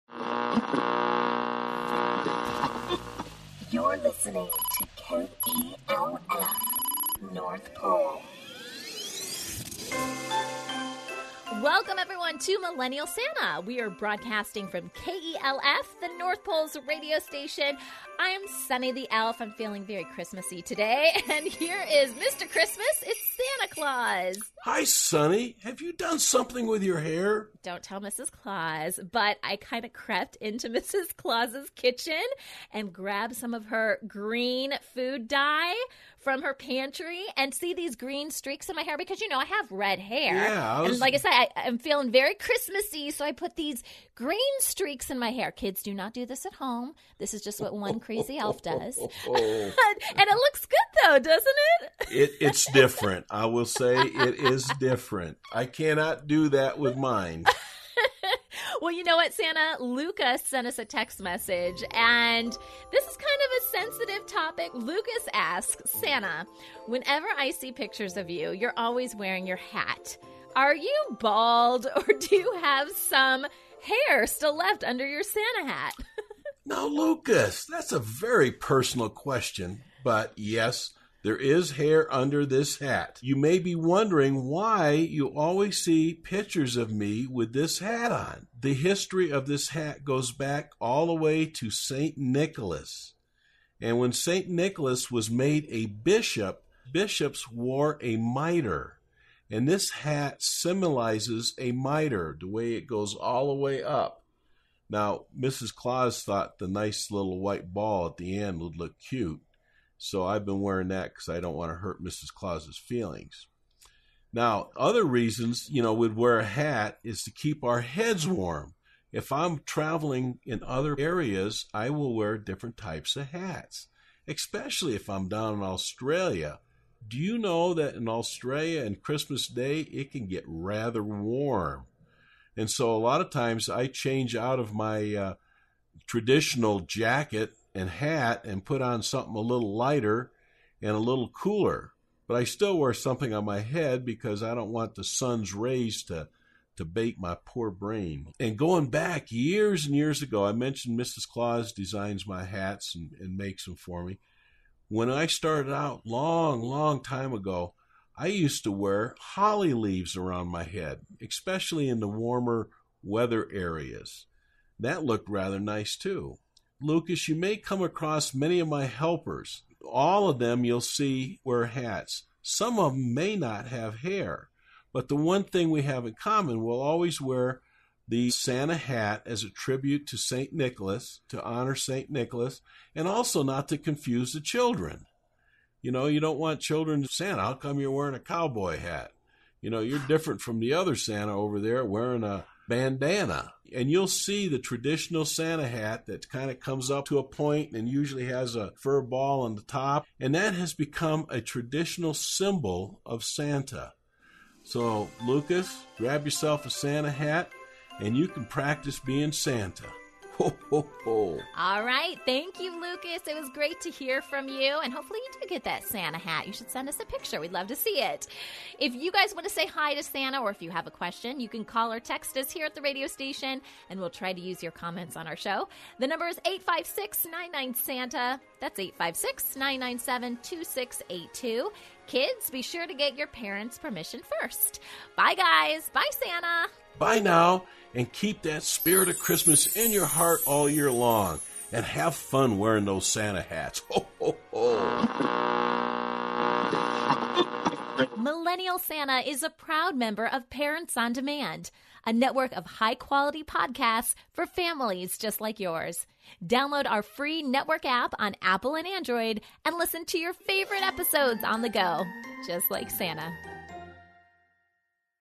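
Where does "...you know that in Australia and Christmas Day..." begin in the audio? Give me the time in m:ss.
2:07.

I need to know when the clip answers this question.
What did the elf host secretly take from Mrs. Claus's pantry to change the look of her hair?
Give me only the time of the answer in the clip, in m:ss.
0:34.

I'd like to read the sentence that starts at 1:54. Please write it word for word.
Now, other reasons, you know, we'd wear a hat is to keep our heads warm.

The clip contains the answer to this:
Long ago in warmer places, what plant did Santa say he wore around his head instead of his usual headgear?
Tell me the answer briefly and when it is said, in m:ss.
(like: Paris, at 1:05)
holly leaves, at 2:39.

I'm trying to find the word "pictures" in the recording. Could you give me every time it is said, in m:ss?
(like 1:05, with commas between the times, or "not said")
1:07, 1:26, 3:37.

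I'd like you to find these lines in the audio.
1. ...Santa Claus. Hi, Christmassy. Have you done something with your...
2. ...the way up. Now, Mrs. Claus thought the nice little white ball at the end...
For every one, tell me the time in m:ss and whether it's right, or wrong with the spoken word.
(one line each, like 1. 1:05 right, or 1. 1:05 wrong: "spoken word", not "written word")
1. 0:23 wrong: "Sunny", not "Christmassy"
2. 1:43 right.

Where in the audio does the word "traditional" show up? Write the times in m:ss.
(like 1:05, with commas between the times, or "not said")
2:16, 3:14, 3:21.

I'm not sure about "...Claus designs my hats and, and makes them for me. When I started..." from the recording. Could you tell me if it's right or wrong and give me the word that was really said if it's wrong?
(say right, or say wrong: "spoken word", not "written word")
right.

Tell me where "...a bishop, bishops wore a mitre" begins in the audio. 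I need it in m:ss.
1:35.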